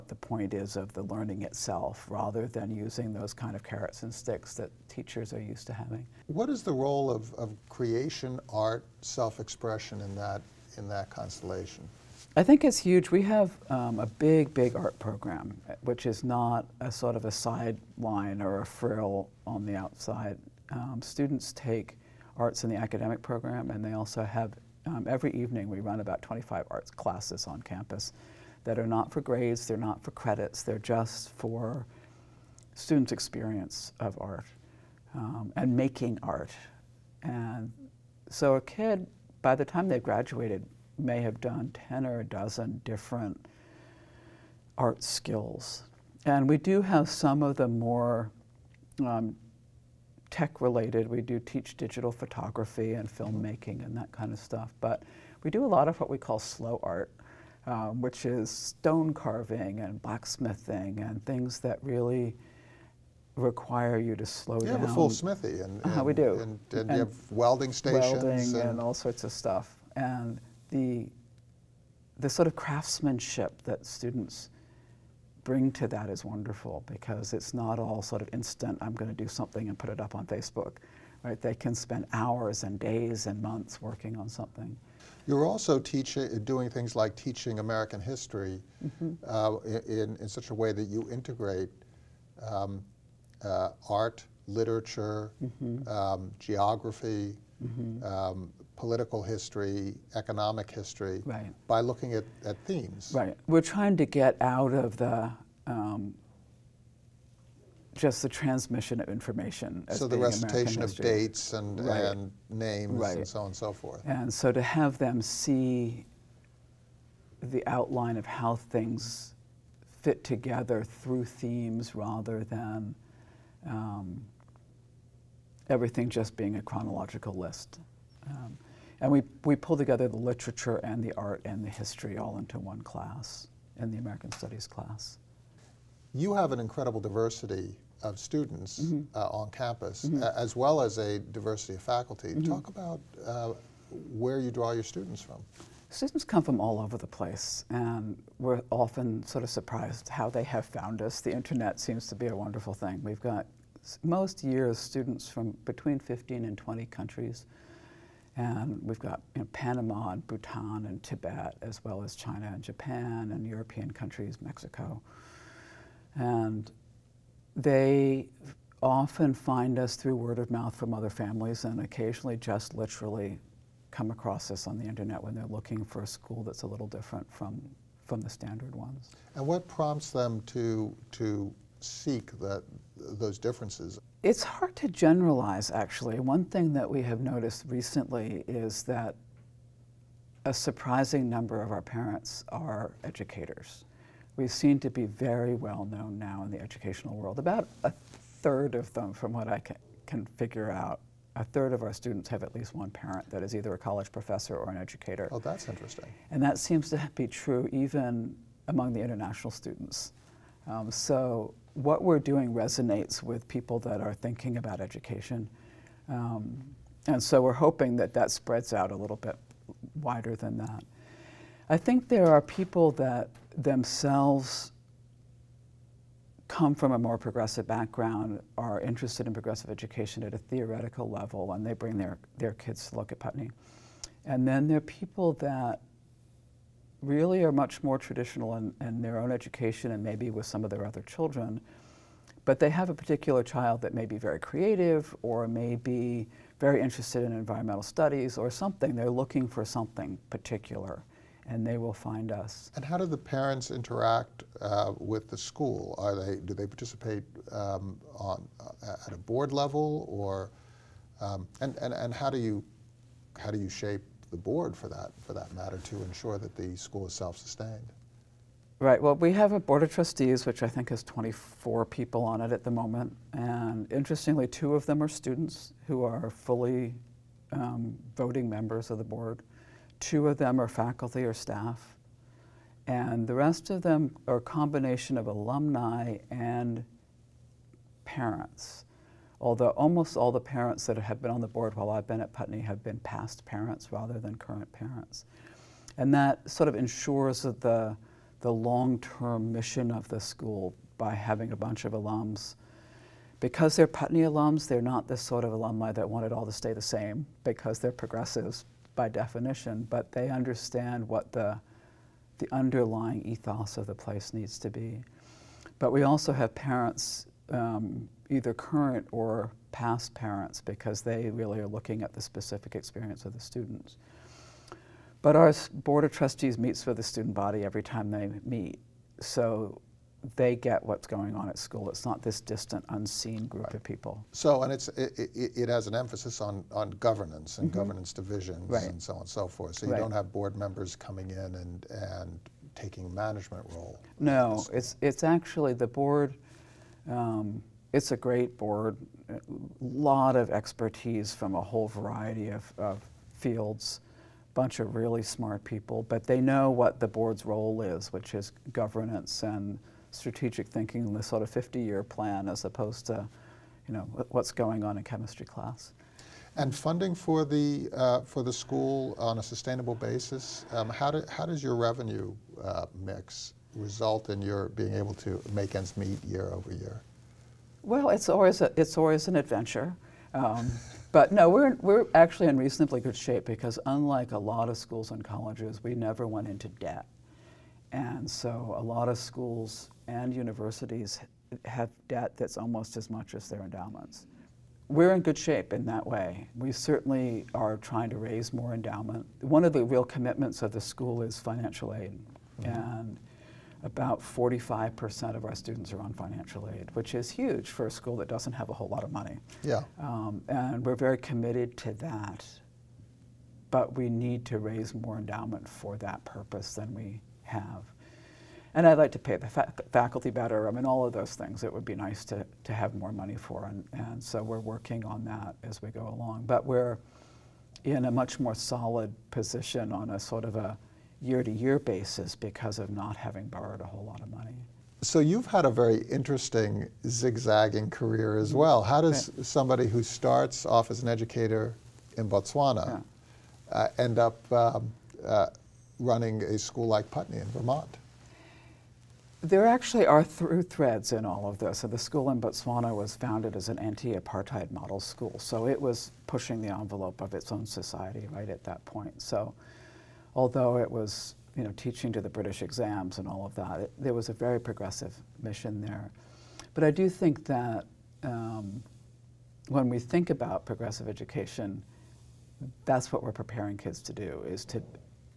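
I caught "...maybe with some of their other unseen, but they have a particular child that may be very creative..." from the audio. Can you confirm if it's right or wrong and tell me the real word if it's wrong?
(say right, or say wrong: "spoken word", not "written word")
wrong: "children", not "unseen".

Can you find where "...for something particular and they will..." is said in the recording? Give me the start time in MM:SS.
04:09.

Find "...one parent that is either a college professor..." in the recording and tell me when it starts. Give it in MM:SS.
03:22.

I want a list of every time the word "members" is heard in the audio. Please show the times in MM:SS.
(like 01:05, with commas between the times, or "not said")
04:38, 05:40.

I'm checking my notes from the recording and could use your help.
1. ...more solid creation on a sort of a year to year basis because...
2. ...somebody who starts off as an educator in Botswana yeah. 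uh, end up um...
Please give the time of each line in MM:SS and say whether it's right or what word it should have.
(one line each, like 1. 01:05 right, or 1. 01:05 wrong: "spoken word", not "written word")
1. 07:08 wrong: "position", not "creation"
2. 07:19 right.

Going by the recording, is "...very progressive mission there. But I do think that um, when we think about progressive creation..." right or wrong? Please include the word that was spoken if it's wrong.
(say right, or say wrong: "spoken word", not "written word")
wrong: "education", not "creation".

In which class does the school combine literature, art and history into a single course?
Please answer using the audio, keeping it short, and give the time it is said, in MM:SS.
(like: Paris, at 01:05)
American Studies, at 02:13.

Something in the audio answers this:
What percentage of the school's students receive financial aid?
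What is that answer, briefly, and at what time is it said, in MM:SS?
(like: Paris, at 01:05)
45%, at 06:43.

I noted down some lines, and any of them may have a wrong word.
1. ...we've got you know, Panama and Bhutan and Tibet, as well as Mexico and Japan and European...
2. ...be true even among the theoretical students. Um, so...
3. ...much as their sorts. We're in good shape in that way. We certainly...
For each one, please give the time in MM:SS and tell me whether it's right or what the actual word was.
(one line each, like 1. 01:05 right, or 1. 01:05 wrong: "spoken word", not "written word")
1. 02:38 wrong: "China", not "Mexico"
2. 03:27 wrong: "international", not "theoretical"
3. 06:33 wrong: "endowments", not "sorts".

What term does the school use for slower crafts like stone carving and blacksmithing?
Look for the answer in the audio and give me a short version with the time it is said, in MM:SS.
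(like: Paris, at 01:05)
slow art, at 00:56.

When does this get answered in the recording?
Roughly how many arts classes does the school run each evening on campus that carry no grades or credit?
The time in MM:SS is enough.
00:26.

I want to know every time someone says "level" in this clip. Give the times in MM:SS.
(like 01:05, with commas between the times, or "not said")
03:51, 04:19.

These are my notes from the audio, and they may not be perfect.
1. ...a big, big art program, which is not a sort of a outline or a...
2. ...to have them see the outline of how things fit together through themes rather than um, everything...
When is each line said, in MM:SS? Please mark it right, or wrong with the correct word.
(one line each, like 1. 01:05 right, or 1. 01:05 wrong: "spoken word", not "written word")
1. 00:13 wrong: "sideline", not "outline"
2. 01:54 right.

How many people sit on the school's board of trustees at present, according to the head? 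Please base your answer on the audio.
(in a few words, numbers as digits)
24.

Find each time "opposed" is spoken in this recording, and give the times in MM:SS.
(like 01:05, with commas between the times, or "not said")
06:02.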